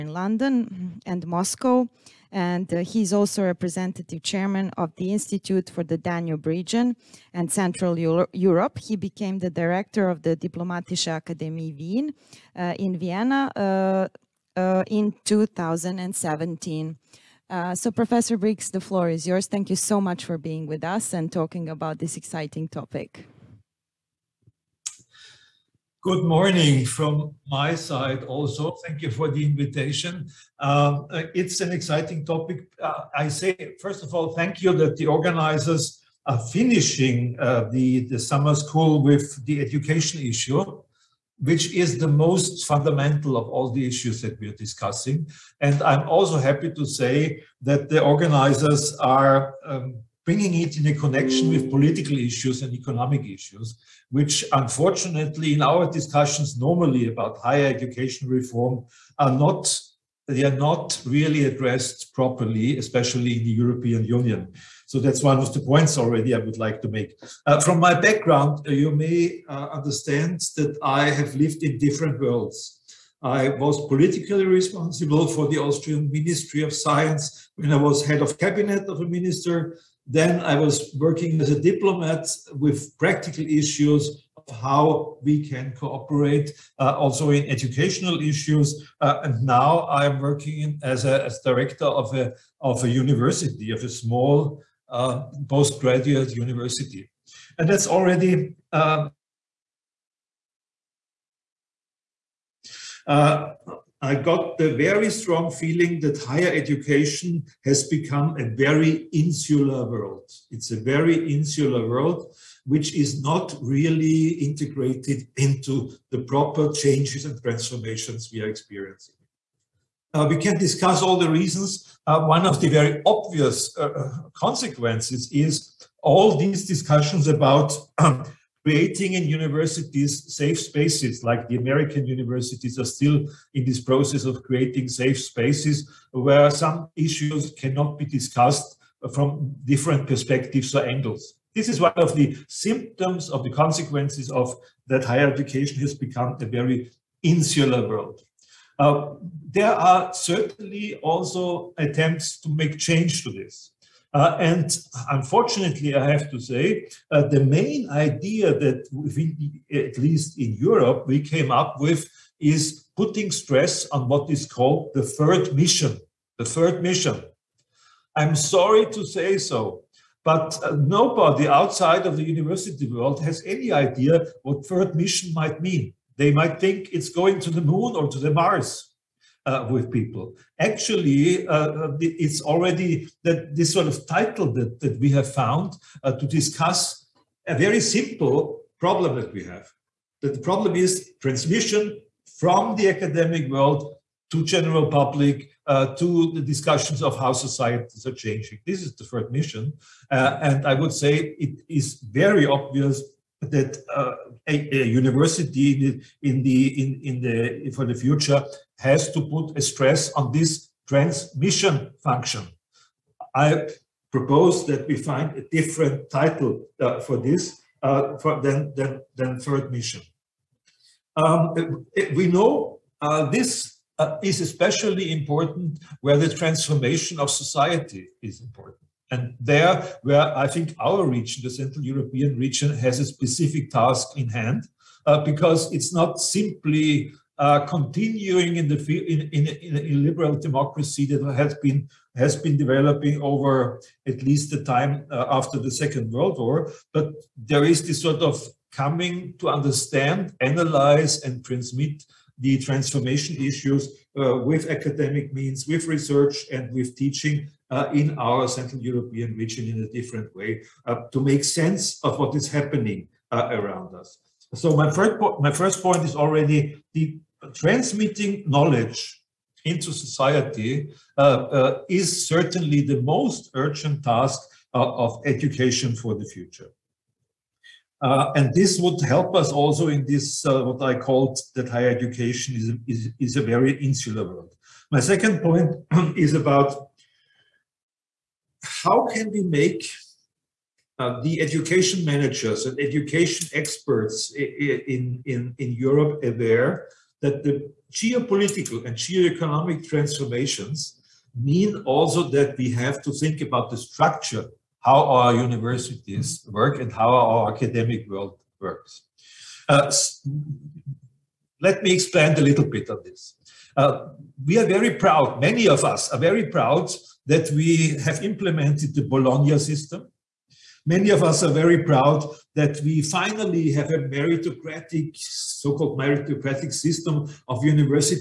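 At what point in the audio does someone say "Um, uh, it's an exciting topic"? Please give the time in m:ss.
0:30.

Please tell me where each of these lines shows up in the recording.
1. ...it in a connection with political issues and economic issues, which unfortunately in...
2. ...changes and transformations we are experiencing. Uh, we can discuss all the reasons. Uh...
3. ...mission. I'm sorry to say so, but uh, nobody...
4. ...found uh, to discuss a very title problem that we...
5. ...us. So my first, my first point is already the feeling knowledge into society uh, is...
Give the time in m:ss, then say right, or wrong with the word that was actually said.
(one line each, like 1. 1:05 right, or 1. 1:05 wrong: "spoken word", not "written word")
1. 0:50 right
2. 1:56 right
3. 2:46 right
4. 3:05 wrong: "simple", not "title"
5. 4:23 wrong: "transmitting", not "feeling".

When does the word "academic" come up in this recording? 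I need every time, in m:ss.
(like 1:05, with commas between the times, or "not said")
3:12, 4:14, 5:07.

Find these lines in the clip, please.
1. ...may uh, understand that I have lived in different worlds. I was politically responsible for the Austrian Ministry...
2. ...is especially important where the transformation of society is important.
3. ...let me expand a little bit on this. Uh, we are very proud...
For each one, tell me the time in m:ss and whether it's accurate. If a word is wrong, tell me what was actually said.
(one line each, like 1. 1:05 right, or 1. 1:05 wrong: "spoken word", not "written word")
1. 1:08 right
2. 3:44 right
3. 5:11 right.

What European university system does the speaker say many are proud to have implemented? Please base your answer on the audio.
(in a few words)
Bologna system.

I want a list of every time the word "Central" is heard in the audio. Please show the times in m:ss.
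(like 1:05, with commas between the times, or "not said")
0:07, 3:51, 4:18.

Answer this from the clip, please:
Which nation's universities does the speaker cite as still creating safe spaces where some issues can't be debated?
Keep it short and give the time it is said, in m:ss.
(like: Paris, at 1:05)
American, at 2:11.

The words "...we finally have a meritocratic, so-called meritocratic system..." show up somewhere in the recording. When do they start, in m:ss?
5:22.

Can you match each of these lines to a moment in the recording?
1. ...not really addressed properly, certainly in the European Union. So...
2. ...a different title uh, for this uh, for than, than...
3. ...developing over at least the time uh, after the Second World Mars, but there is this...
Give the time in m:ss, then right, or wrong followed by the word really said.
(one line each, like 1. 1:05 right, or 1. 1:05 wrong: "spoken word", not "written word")
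1. 1:00 wrong: "especially", not "certainly"
2. 3:35 right
3. 4:02 wrong: "War", not "Mars".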